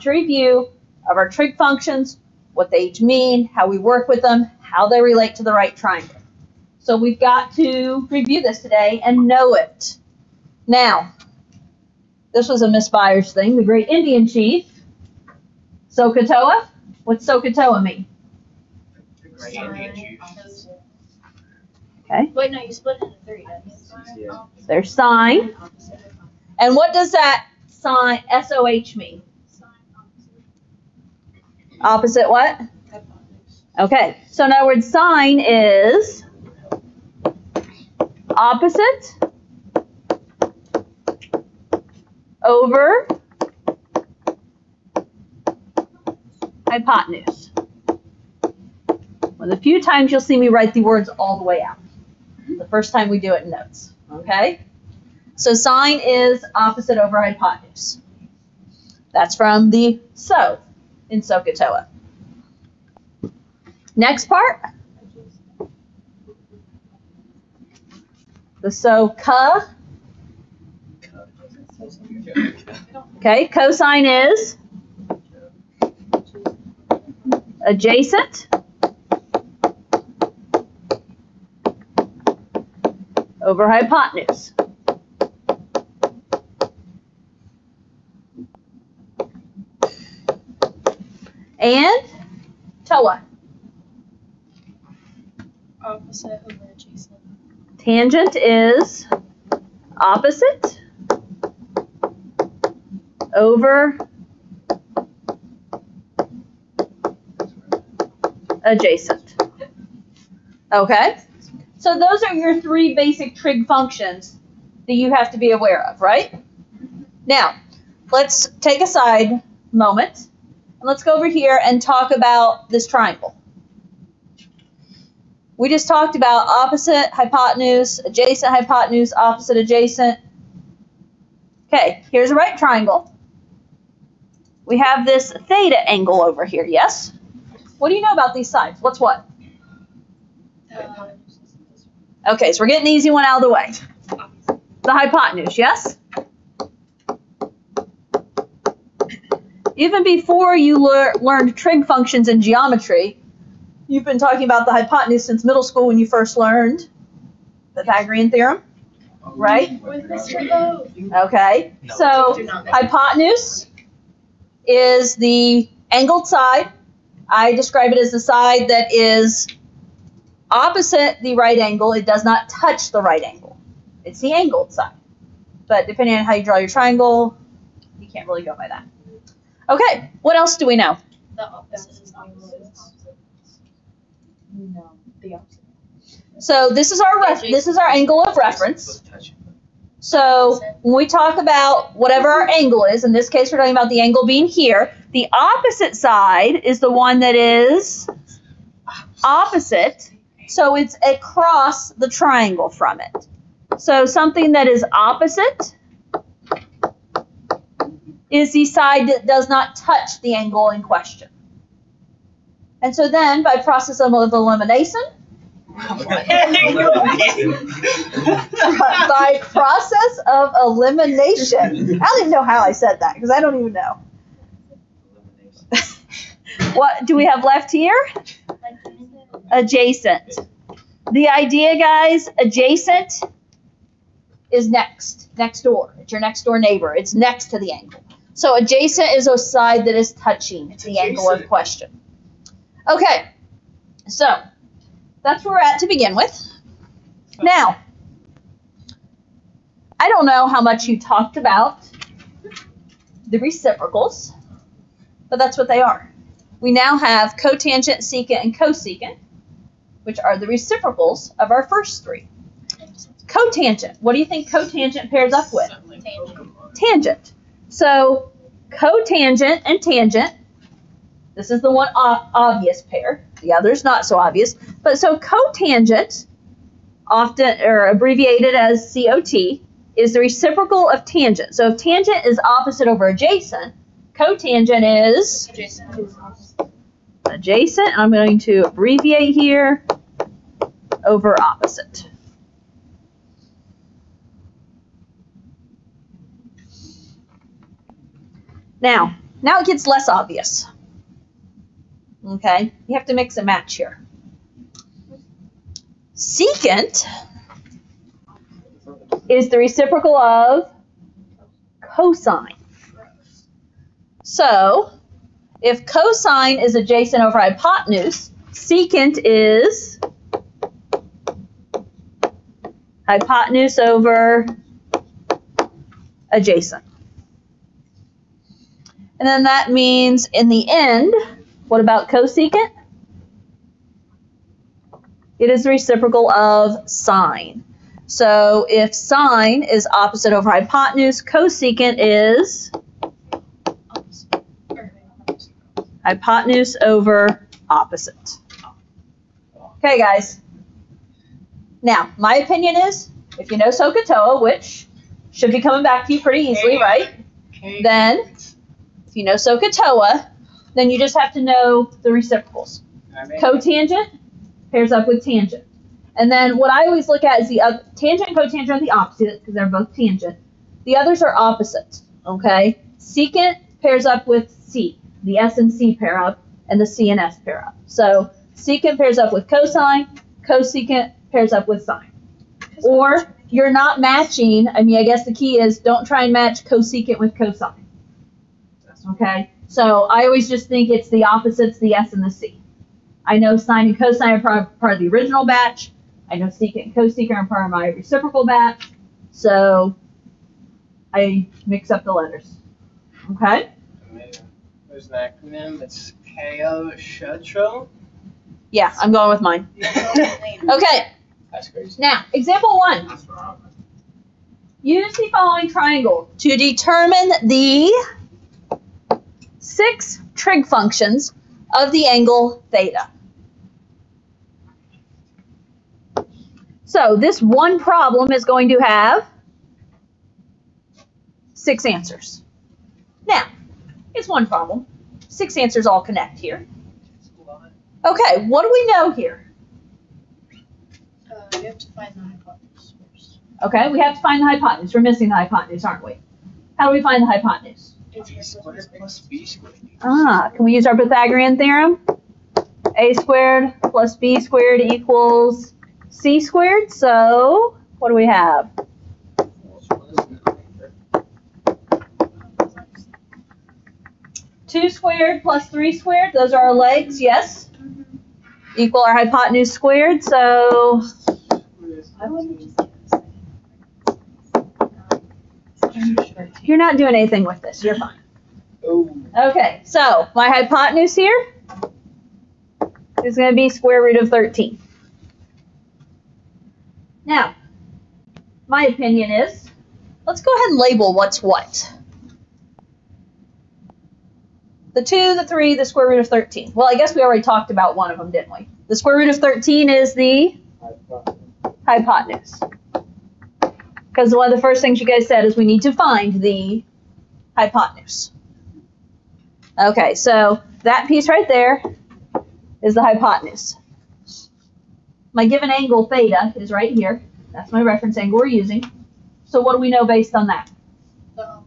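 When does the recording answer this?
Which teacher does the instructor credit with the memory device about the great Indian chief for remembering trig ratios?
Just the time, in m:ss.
0:12.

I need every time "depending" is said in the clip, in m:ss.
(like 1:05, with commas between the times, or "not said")
2:55.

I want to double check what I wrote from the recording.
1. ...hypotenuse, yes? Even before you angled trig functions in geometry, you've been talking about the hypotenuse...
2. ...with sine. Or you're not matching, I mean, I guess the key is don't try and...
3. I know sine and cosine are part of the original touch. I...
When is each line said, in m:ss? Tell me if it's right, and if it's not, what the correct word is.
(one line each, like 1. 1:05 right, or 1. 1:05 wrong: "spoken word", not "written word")
1. 2:24 wrong: "learned", not "angled"
2. 6:21 right
3. 6:33 wrong: "batch", not "touch".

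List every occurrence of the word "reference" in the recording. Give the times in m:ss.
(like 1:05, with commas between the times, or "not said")
3:08, 8:37.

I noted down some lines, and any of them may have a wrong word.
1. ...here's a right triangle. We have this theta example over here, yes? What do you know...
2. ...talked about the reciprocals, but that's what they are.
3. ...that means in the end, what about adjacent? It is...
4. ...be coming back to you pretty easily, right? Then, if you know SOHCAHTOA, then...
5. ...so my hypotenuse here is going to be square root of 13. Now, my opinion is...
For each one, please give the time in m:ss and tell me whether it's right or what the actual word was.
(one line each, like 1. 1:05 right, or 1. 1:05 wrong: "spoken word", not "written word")
1. 2:12 wrong: "angle", not "example"
2. 4:11 right
3. 5:29 wrong: "cosecant", not "adjacent"
4. 5:55 right
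5. 7:59 right.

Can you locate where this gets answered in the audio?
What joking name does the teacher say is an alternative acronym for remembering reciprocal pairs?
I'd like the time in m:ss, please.
6:46.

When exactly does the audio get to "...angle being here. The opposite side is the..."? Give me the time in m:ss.
3:14.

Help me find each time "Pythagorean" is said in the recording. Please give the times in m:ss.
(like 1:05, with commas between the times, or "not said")
2:37, 7:30.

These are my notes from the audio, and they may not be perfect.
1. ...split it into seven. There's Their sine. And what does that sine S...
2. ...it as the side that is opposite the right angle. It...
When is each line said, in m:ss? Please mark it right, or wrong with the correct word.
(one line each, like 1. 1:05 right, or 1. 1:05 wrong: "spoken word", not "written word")
1. 0:22 wrong: "three", not "seven"
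2. 2:47 right.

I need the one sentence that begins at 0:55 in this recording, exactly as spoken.
So sine is opposite over hypotenuse.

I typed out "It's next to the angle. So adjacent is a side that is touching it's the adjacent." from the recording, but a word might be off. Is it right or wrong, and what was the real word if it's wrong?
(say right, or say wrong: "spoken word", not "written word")
right.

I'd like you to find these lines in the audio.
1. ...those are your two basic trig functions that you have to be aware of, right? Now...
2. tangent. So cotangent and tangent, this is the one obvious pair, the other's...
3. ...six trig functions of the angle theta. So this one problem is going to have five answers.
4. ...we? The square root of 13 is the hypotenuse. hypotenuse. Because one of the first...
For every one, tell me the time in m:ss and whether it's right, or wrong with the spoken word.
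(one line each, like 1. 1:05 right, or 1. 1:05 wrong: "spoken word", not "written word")
1. 1:51 wrong: "three", not "two"
2. 4:26 right
3. 6:59 wrong: "six", not "five"
4. 8:18 right.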